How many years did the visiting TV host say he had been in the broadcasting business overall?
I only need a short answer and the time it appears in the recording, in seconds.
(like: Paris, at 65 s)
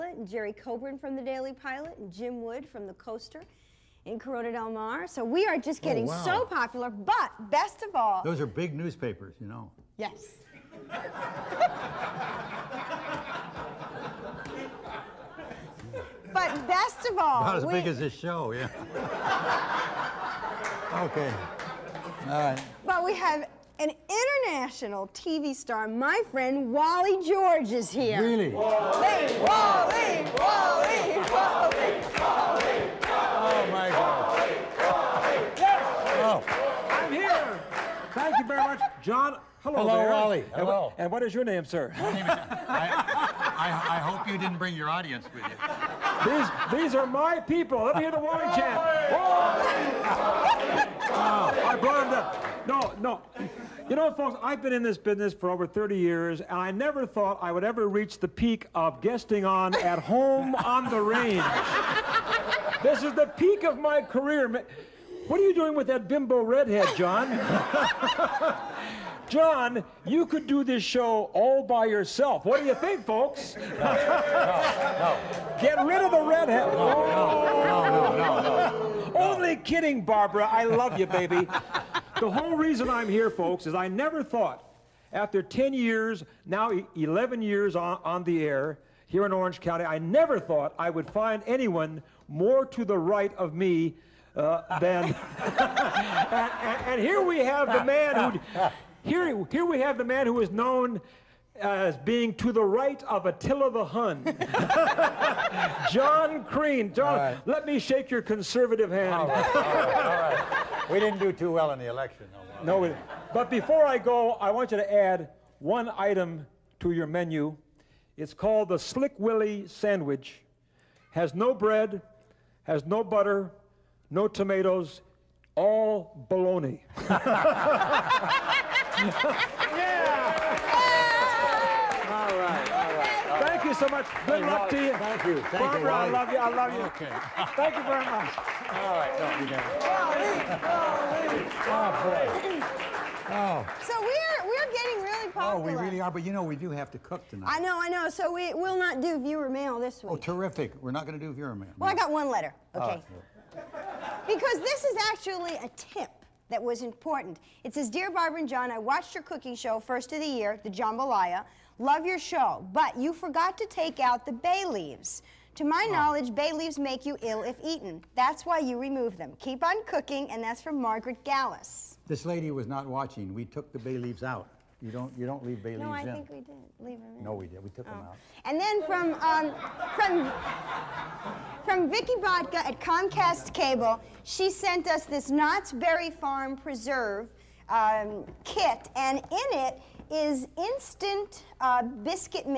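over 30, at 55 s.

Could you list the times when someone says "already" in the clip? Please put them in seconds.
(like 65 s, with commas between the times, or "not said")
not said.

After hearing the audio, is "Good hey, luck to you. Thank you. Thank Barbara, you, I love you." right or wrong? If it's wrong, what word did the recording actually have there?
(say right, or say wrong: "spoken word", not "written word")
right.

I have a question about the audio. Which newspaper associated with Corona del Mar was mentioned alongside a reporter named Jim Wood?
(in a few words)
the Coaster.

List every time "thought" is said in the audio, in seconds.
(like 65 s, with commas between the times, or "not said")
57 s, 84 s, 90 s.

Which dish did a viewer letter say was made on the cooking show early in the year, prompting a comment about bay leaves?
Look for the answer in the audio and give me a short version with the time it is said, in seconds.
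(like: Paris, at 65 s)
Jambalaya, at 160 s.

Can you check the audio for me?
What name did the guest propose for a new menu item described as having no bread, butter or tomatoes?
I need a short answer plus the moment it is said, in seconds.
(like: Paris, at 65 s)
Slick Willie sandwich, at 118 s.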